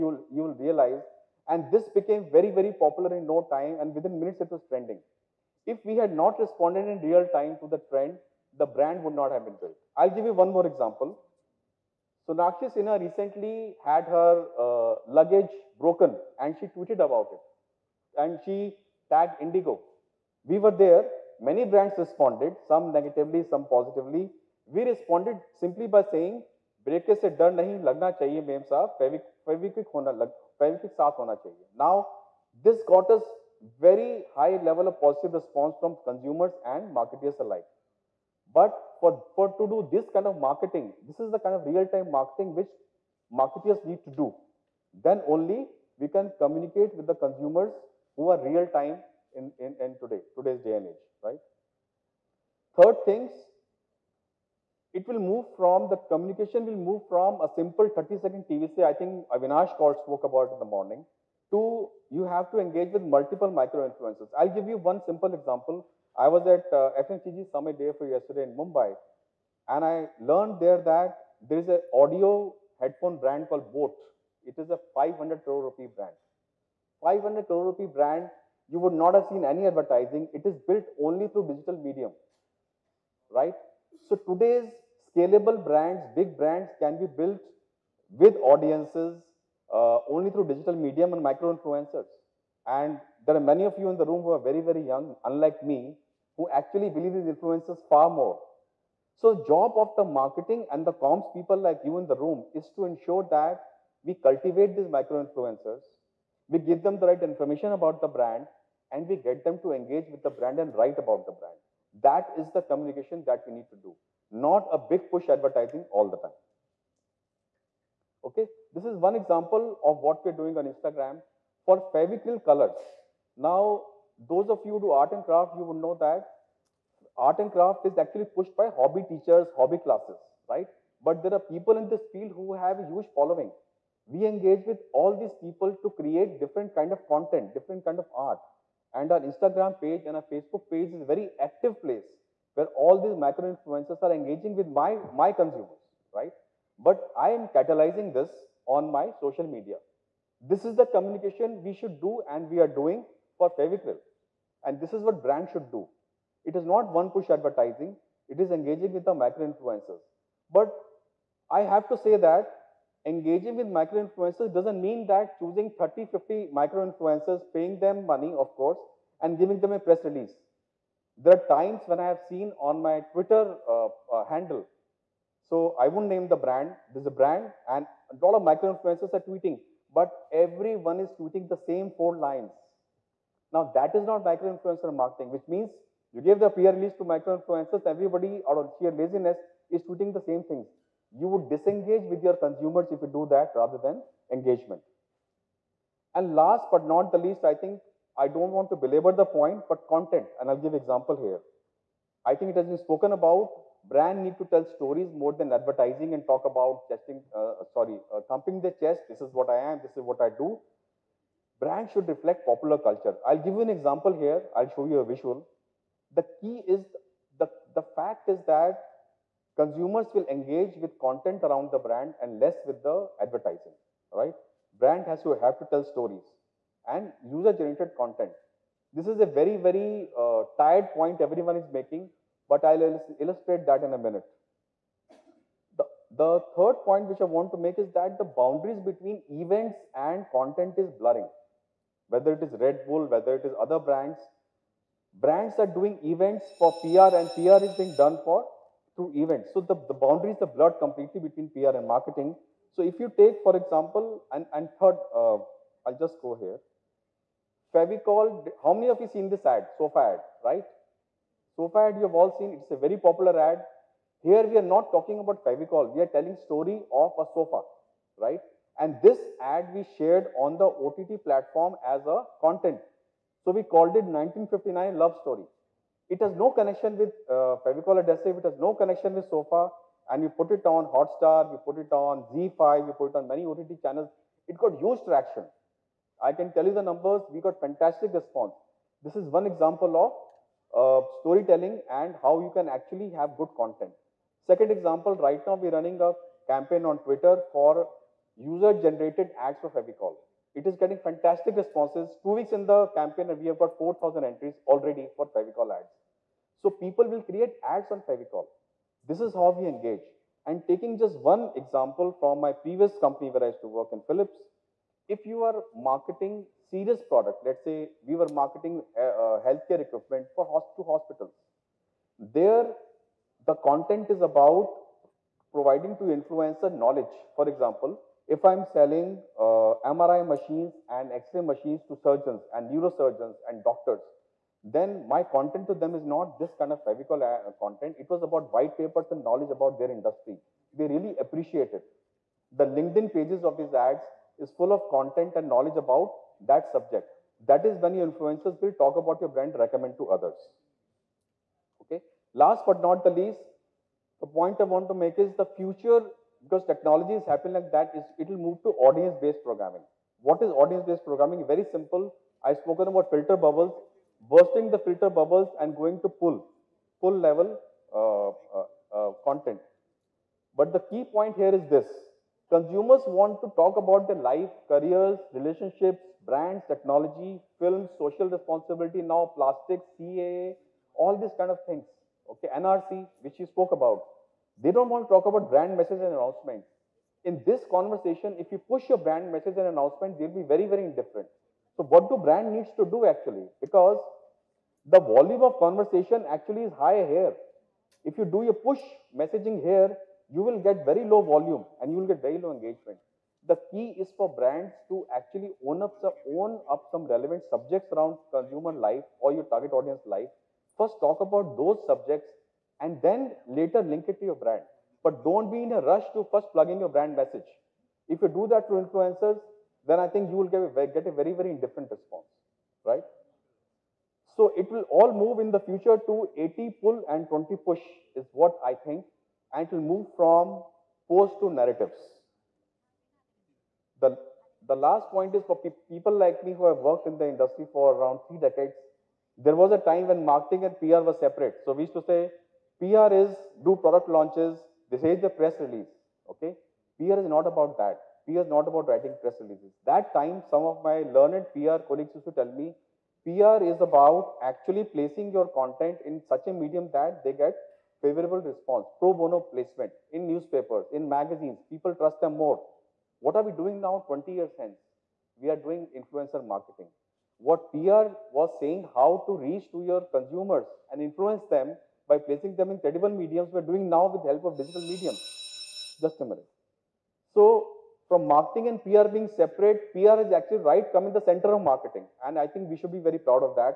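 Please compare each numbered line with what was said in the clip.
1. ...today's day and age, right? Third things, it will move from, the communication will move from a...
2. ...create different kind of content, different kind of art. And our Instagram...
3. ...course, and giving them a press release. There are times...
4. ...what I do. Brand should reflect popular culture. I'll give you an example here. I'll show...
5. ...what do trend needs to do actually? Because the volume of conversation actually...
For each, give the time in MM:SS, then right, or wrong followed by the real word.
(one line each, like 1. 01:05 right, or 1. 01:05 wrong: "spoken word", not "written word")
1. 00:50 right
2. 02:15 right
3. 02:48 right
4. 03:30 right
5. 06:31 wrong: "brand", not "trend".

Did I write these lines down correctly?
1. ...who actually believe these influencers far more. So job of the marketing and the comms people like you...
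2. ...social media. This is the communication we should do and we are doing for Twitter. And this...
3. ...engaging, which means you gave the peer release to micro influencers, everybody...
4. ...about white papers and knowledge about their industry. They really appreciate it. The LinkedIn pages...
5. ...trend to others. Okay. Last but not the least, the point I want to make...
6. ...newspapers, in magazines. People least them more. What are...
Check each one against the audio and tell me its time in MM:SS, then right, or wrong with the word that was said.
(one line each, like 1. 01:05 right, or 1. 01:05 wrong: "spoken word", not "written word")
1. 01:36 right
2. 02:29 wrong: "Fevicryl", not "Twitter"
3. 03:04 wrong: "marketing", not "engaging"
4. 05:38 right
5. 05:49 wrong: "recommend", not "trend"
6. 07:40 wrong: "trust", not "least".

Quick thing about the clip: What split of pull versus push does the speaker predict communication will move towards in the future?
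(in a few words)
80 pull and 20 push.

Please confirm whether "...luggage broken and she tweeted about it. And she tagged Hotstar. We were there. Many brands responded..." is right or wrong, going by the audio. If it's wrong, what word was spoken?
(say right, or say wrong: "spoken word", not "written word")
wrong: "Indigo", not "Hotstar".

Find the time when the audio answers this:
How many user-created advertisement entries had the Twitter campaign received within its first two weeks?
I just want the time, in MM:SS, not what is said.
05:03.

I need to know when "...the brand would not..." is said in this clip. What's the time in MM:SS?
00:08.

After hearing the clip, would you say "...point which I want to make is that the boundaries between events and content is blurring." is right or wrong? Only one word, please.
right.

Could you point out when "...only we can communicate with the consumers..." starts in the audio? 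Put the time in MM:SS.
00:45.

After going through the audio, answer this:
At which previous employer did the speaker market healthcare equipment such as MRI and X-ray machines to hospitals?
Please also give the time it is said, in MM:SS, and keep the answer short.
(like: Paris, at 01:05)
Philips, at 05:14.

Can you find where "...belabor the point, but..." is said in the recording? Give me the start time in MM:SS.
03:18.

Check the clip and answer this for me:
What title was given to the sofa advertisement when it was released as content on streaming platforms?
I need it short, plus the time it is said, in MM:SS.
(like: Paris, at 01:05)
1959 Love Story, at 04:34.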